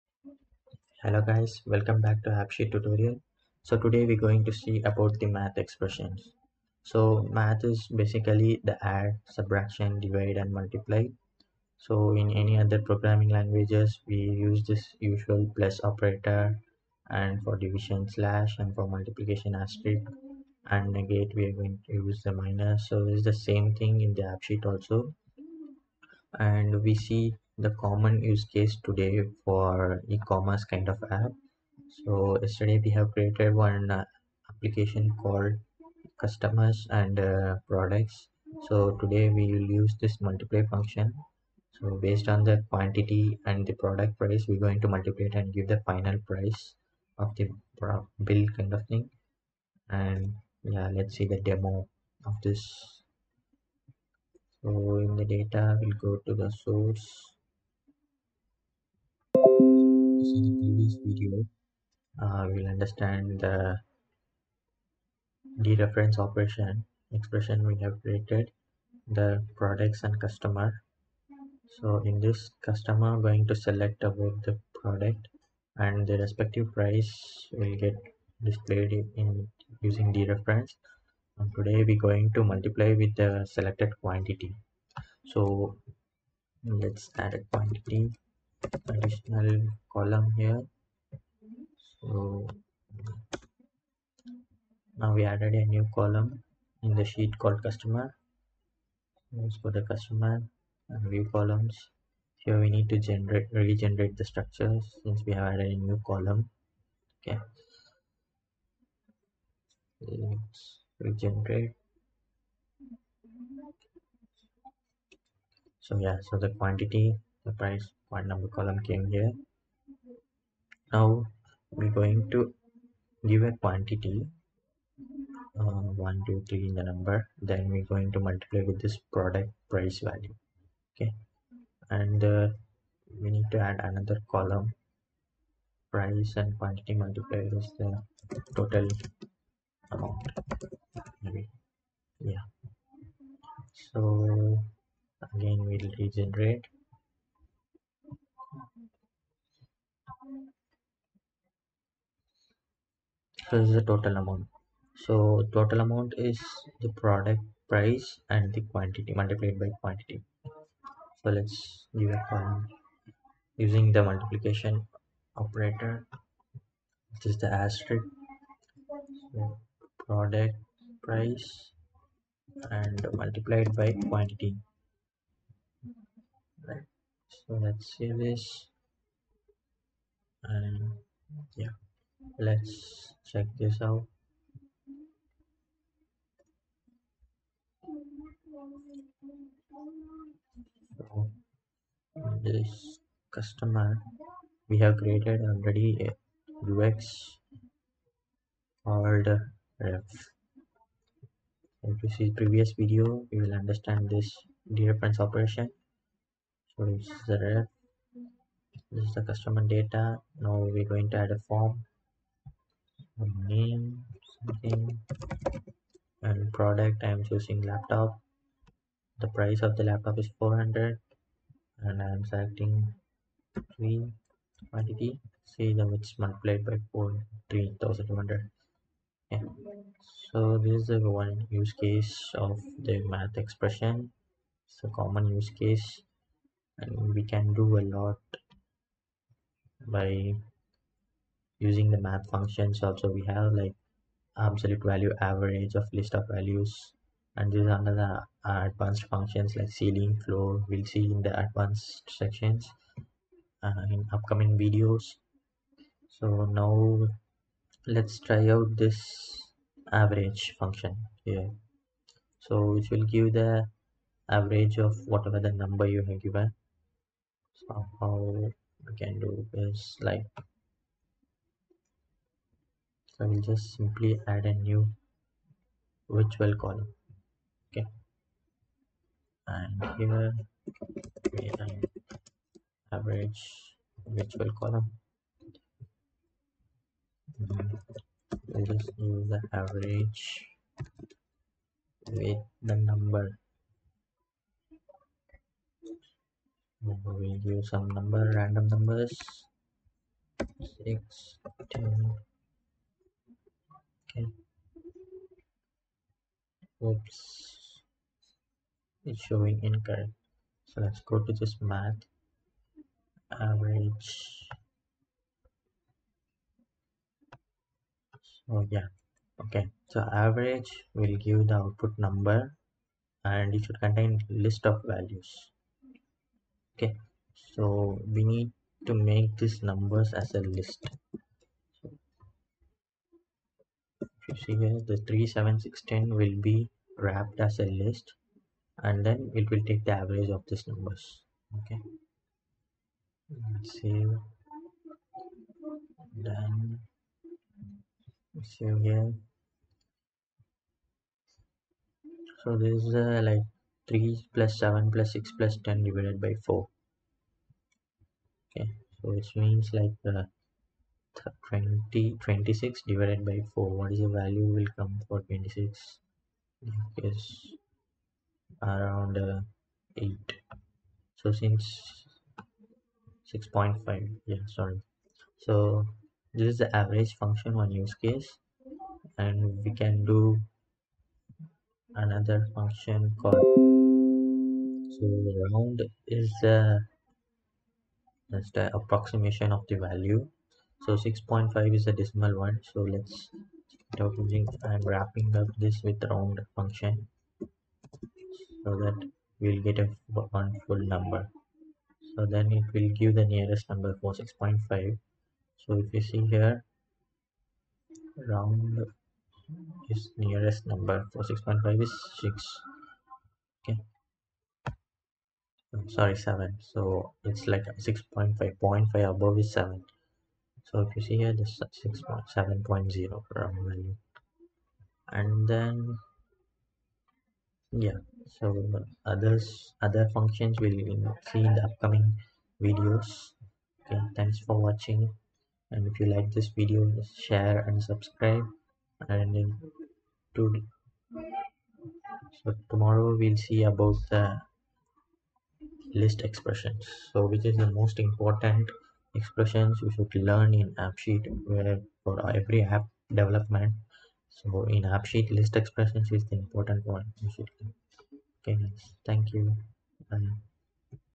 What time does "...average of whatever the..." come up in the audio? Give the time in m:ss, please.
4:24.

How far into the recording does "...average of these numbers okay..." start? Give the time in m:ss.
5:40.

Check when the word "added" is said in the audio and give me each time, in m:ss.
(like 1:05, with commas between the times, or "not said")
1:35, 1:45.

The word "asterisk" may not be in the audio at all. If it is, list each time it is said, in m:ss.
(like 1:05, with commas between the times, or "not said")
0:19, 2:47.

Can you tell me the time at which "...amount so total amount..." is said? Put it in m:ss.
2:34.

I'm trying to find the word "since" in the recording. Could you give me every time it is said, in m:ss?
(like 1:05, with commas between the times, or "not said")
1:45, 6:11.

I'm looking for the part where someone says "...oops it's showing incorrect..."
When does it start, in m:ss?
5:06.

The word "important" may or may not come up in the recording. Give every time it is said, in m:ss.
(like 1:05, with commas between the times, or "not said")
7:27, 7:36.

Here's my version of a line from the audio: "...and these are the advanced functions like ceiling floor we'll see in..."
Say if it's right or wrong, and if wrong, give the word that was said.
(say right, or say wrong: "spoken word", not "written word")
right.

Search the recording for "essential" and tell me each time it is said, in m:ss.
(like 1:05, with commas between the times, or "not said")
not said.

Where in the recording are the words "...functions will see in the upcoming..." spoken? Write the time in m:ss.
7:10.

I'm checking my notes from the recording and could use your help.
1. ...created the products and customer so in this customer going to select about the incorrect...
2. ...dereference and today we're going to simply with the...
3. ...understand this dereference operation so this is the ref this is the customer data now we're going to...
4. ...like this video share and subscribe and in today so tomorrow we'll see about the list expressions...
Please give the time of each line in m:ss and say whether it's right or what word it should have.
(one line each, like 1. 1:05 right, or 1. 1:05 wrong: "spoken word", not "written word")
1. 1:08 wrong: "product", not "incorrect"
2. 1:20 wrong: "multiply", not "simply"
3. 3:23 right
4. 7:16 right.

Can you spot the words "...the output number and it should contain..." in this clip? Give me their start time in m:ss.
5:21.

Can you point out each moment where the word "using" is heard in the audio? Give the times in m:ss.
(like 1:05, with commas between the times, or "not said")
1:19, 2:43, 4:01, 6:34.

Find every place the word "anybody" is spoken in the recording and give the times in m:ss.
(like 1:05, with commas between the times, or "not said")
not said.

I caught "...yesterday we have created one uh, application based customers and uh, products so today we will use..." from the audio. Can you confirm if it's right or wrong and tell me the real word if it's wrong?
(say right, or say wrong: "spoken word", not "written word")
wrong: "called", not "based".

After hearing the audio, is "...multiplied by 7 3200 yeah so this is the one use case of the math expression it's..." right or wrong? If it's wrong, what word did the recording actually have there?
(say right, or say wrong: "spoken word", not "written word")
wrong: "4", not "7".